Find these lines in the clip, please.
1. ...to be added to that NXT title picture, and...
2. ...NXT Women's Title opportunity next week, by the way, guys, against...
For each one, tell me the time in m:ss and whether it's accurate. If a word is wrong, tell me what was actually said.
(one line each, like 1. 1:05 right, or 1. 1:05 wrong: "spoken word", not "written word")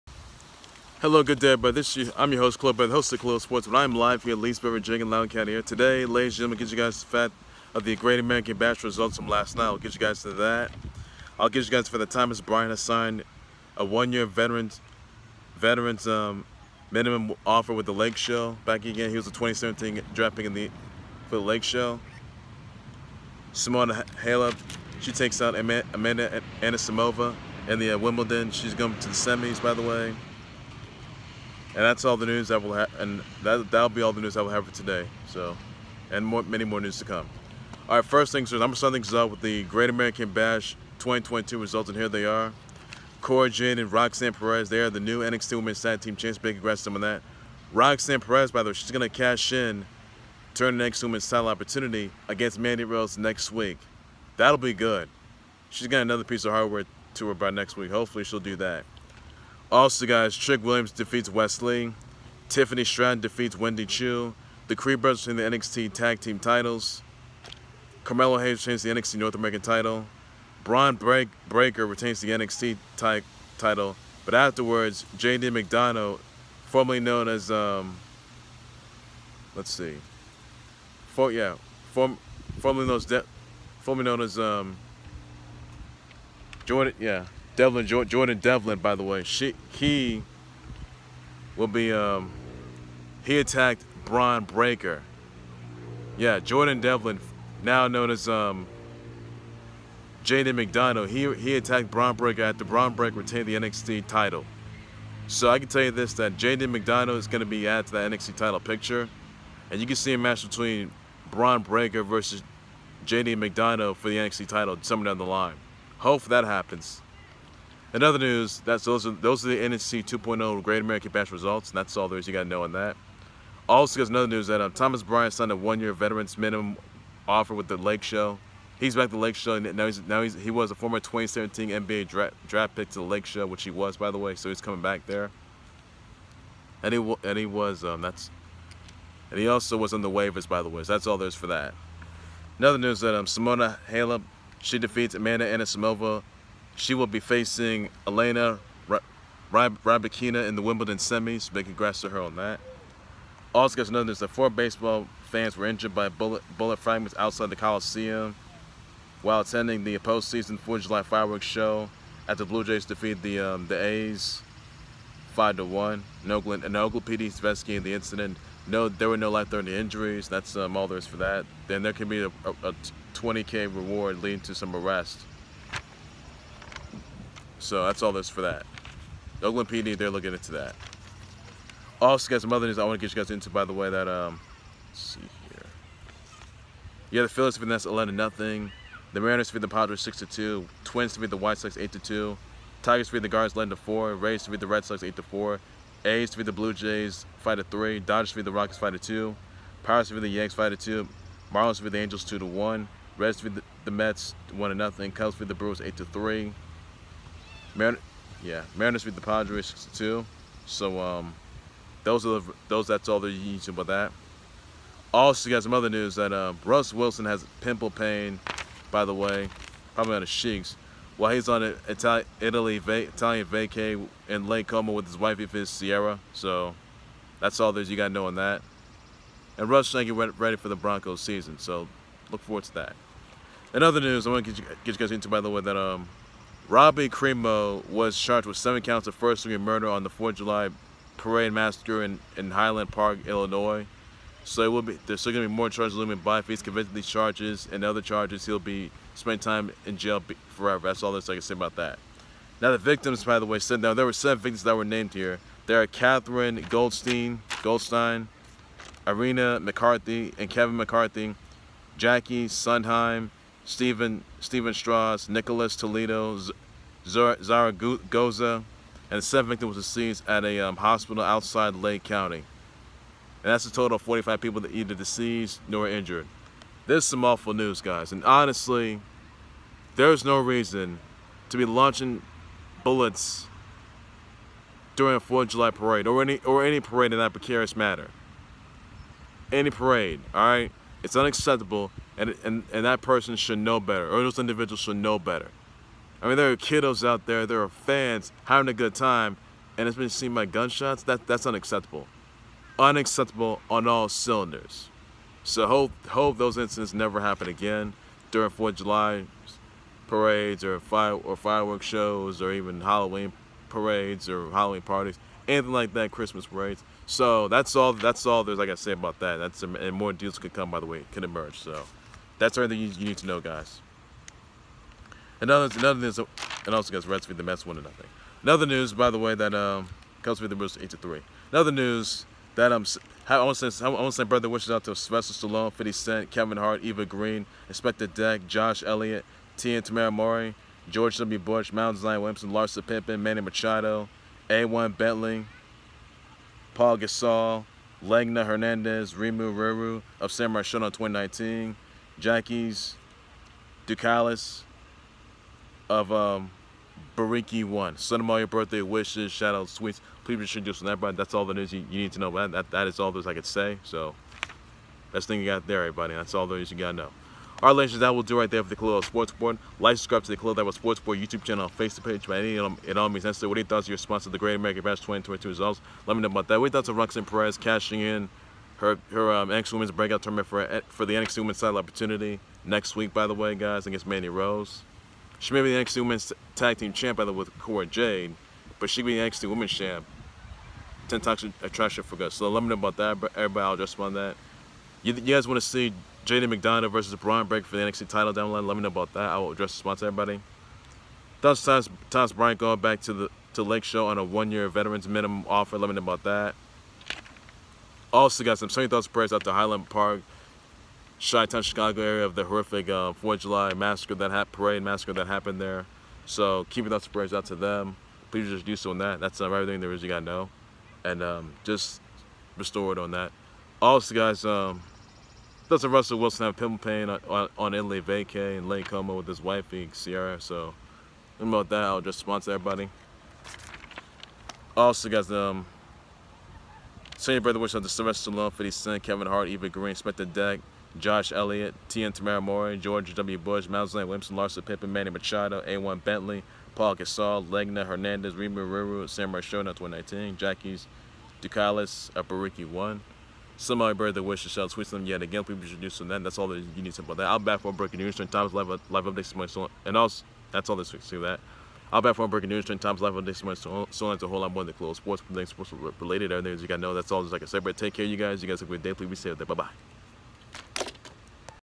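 1. 1:47 right
2. 6:21 right.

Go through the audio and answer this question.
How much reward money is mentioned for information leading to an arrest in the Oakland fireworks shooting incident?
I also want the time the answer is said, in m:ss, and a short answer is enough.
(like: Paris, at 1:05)
20K, at 2:53.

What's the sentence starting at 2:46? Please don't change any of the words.
An Oakland, and Oakland PD is investigating the incident.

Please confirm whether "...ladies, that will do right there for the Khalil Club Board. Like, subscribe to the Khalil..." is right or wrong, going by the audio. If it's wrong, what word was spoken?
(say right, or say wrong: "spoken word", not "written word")
wrong: "Sports", not "Club".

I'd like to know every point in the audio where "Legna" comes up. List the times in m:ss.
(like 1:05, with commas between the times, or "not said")
5:48, 7:27.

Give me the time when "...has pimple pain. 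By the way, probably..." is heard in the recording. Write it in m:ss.
3:37.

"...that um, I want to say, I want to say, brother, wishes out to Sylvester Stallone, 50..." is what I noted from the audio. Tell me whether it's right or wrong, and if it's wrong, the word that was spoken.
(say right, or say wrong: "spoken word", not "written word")
right.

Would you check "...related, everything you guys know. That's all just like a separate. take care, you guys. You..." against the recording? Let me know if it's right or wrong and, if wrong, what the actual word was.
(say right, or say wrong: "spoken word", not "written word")
right.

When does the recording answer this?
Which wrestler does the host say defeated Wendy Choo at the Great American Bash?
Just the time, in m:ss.
1:02.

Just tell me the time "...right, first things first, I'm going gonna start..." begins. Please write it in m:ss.
0:37.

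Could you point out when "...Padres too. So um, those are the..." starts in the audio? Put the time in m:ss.
3:29.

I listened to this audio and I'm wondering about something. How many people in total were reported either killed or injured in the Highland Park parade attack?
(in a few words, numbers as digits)
45.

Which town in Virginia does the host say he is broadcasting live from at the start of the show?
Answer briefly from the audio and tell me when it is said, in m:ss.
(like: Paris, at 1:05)
Leesburg, at 0:04.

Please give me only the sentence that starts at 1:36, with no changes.
Yeah, Jordan Devlin, now known as um, JD McDonagh, he he attacked Bron Breakker after Bron Breakker retained the NXT title.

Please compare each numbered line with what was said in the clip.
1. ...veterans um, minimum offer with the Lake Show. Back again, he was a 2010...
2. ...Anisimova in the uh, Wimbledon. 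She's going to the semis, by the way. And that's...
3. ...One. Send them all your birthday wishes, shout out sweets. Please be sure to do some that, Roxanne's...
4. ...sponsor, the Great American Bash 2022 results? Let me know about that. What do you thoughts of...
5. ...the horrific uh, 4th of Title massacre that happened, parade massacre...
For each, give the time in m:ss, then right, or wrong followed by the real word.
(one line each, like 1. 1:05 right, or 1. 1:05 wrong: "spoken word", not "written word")
1. 0:15 wrong: "2017", not "2010"
2. 0:26 right
3. 5:57 wrong: "That", not "Roxanne"
4. 6:13 right
5. 6:52 wrong: "July", not "Title".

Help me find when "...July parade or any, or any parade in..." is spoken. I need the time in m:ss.
4:45.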